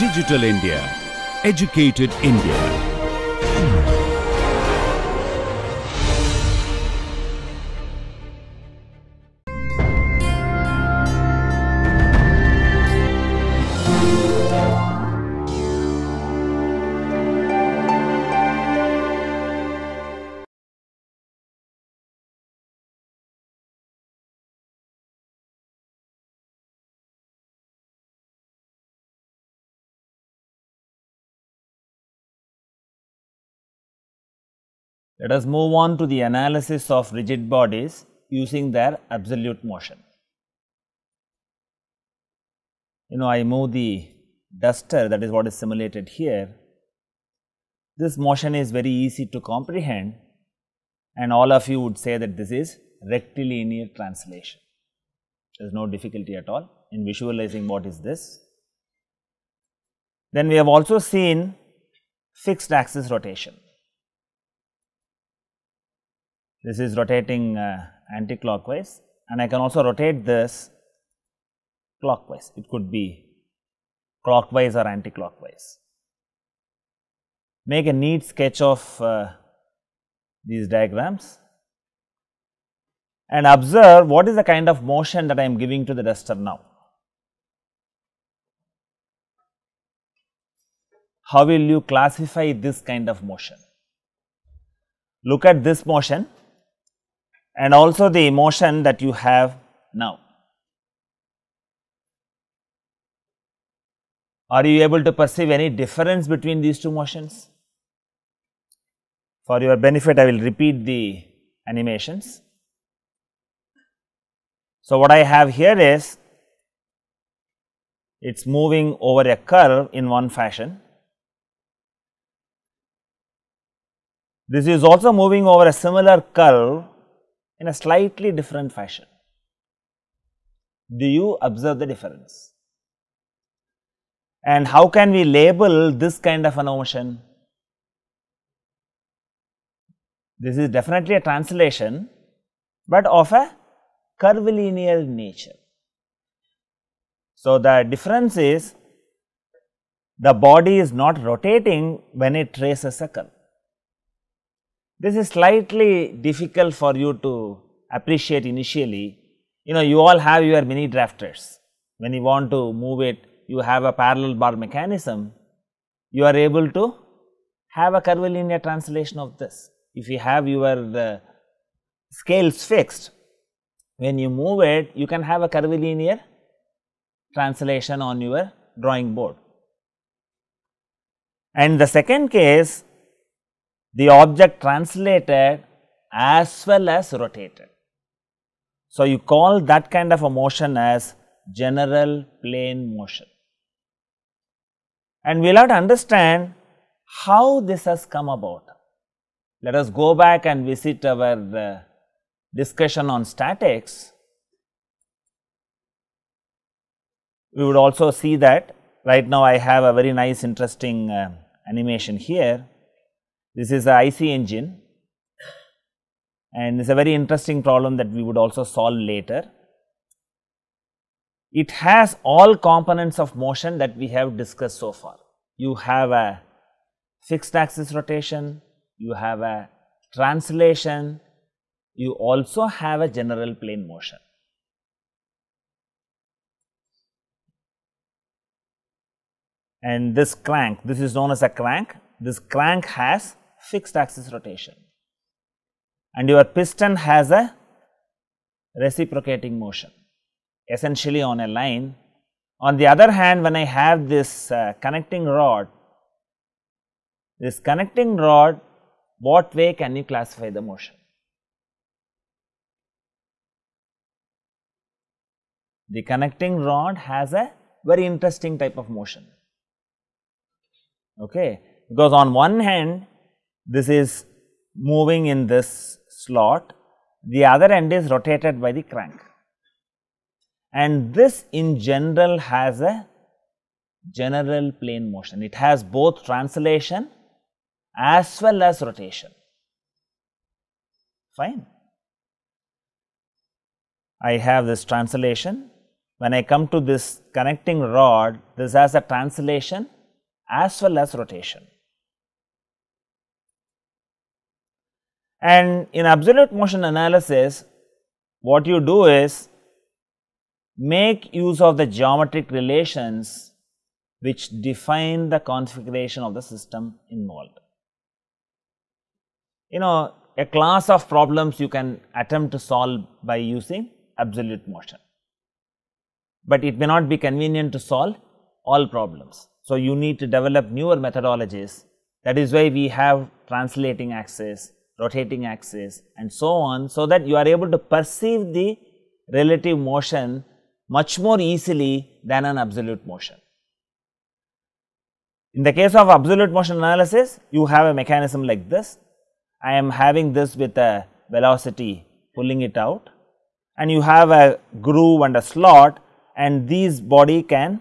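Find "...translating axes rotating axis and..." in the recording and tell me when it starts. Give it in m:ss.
5:33.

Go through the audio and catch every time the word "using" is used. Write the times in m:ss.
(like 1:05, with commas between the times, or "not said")
0:38, 5:23.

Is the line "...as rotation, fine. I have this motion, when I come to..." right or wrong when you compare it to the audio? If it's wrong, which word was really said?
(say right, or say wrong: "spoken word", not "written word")
wrong: "translation", not "motion".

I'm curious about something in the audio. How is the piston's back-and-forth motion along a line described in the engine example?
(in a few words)
Reciprocating.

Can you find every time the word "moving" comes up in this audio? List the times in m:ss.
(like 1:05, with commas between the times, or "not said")
1:58, 2:05, 4:34.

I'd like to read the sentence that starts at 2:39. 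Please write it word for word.
You know, you all have your mini drafters.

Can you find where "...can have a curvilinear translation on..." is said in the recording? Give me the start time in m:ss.
2:55.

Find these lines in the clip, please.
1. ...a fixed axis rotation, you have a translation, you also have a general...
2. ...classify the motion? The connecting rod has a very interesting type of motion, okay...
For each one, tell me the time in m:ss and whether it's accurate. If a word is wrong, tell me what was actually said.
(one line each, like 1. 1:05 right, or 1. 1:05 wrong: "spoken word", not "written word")
1. 3:46 right
2. 4:20 right.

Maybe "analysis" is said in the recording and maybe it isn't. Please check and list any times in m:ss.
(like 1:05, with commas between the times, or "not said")
0:36, 5:06, 5:46.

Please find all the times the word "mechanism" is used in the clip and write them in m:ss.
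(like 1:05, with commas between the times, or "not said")
2:44, 5:47.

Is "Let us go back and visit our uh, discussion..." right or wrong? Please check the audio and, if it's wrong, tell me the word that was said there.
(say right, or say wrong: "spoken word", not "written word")
right.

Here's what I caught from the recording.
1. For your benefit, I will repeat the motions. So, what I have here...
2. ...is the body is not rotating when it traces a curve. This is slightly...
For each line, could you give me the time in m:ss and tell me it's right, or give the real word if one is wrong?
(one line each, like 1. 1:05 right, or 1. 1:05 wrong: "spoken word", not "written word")
1. 1:49 wrong: "animations", not "motions"
2. 2:28 right.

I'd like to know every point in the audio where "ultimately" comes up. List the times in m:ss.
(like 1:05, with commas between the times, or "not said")
not said.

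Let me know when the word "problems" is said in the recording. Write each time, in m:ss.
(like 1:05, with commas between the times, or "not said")
3:37, 5:21, 5:28.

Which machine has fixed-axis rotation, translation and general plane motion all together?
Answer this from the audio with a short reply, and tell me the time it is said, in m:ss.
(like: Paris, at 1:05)
IC engine, at 3:34.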